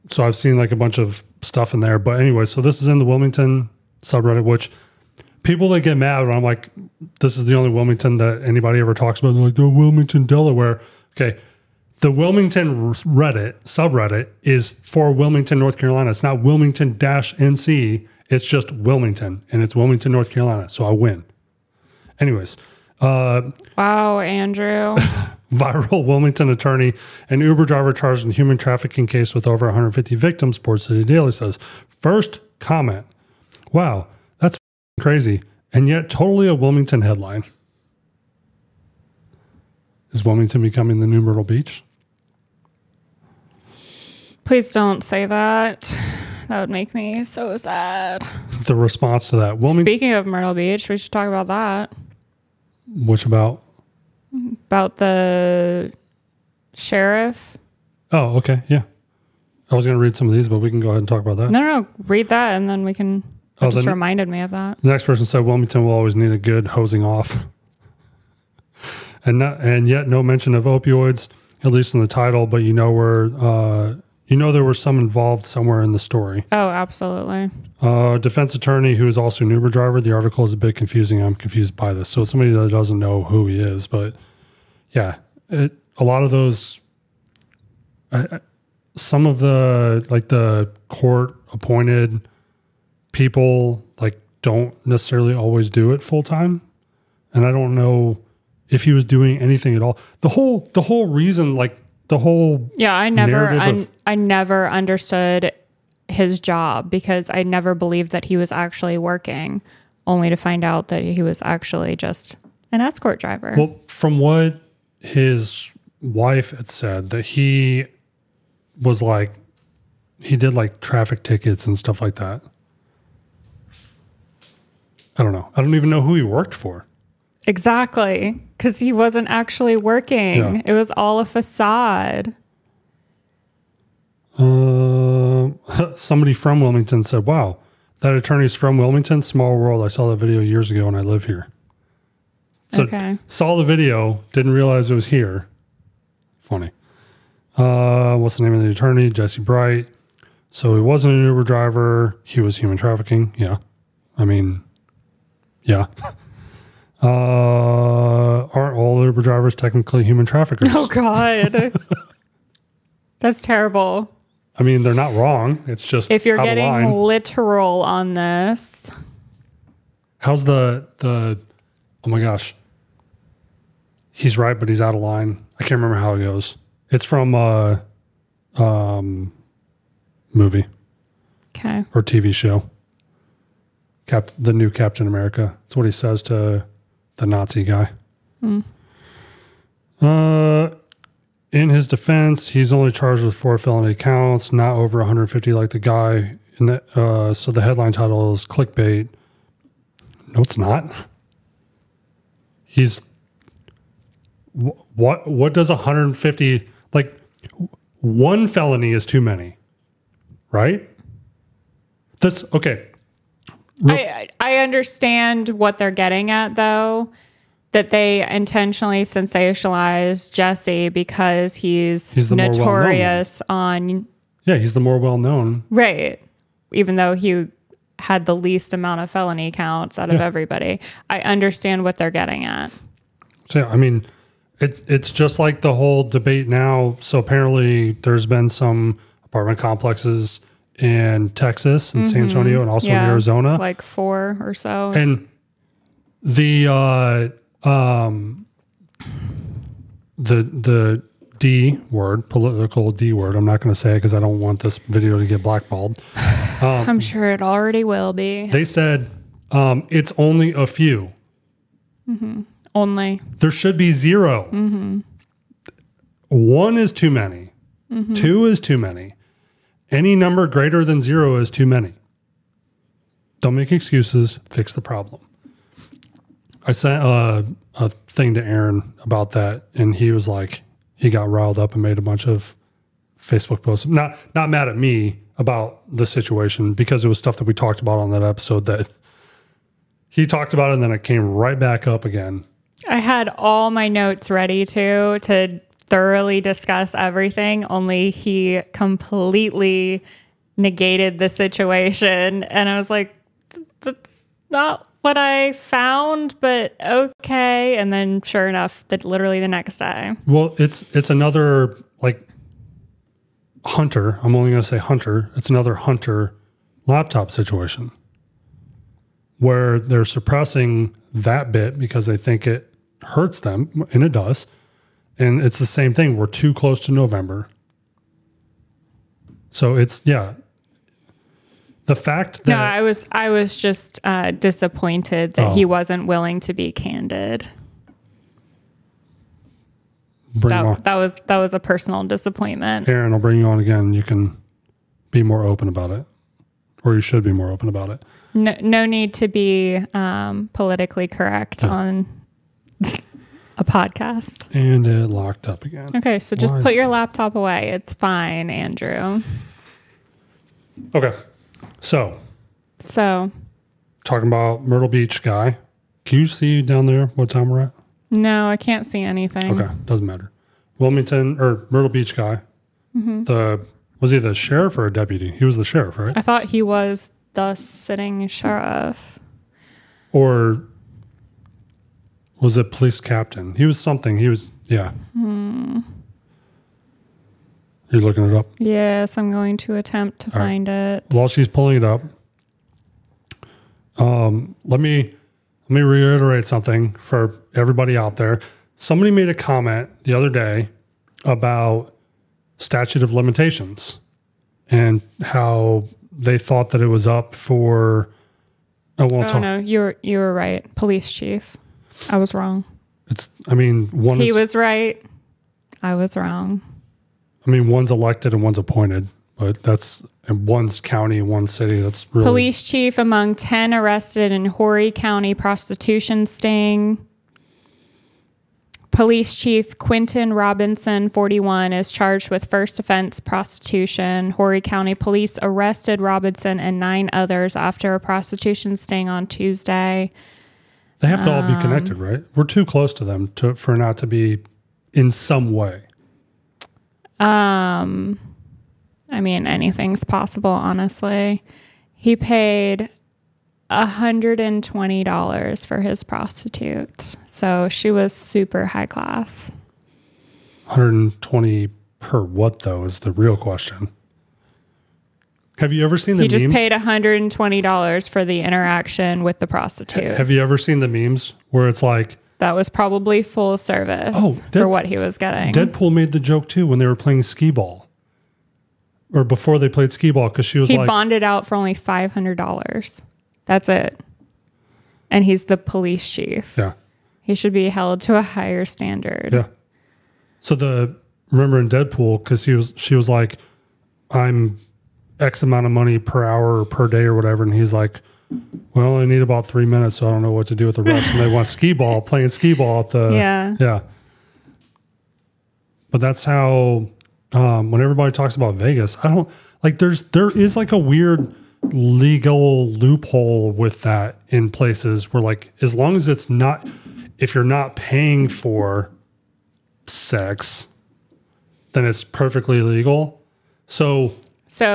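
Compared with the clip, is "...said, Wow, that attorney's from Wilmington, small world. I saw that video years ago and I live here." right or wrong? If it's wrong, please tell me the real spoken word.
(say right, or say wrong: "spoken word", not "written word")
right.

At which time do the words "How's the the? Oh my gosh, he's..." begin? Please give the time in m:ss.
2:50.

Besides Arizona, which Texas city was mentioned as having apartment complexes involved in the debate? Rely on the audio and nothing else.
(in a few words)
San Antonio.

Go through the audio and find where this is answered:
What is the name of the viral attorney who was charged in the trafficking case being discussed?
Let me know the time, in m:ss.
2:29.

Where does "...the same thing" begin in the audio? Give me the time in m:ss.
5:25.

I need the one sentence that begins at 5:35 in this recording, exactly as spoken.
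he wasn't willing to be candid.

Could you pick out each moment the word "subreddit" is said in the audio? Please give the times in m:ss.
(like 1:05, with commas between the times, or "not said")
0:04, 0:13.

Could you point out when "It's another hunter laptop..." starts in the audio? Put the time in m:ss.
5:15.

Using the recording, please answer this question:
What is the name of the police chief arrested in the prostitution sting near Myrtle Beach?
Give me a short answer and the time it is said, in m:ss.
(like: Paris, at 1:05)
Quinton Robinson, at 7:09.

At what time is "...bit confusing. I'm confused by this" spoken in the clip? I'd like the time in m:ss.
1:20.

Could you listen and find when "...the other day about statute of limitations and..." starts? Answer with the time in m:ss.
6:40.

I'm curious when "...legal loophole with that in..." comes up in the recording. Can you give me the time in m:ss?
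8:31.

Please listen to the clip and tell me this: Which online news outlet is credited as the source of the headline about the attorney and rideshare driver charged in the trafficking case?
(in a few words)
Port City Daily.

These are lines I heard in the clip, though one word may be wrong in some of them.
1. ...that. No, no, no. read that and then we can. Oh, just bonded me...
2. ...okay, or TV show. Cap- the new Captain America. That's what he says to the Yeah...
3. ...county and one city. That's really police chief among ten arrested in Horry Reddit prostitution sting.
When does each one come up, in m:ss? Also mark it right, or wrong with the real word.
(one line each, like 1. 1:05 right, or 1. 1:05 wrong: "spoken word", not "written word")
1. 1:01 wrong: "reminded", not "bonded"
2. 3:01 wrong: "Nazi", not "Yeah"
3. 7:00 wrong: "County", not "Reddit".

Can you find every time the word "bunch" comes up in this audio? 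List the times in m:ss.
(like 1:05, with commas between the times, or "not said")
0:00, 4:42.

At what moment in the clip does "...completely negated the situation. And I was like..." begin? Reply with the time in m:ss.
4:58.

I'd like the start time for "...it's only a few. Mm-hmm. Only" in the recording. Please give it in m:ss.
4:19.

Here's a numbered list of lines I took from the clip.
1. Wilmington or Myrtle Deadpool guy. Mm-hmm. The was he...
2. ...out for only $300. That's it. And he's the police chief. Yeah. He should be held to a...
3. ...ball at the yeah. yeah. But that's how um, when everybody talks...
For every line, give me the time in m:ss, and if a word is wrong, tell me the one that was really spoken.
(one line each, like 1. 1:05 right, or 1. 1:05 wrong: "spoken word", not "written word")
1. 6:10 wrong: "Beach", not "Deadpool"
2. 8:01 wrong: "500", not "300"
3. 8:22 right.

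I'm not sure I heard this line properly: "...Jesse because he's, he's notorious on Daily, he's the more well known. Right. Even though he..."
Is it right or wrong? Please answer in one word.
wrong.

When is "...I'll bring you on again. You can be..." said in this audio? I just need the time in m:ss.
5:43.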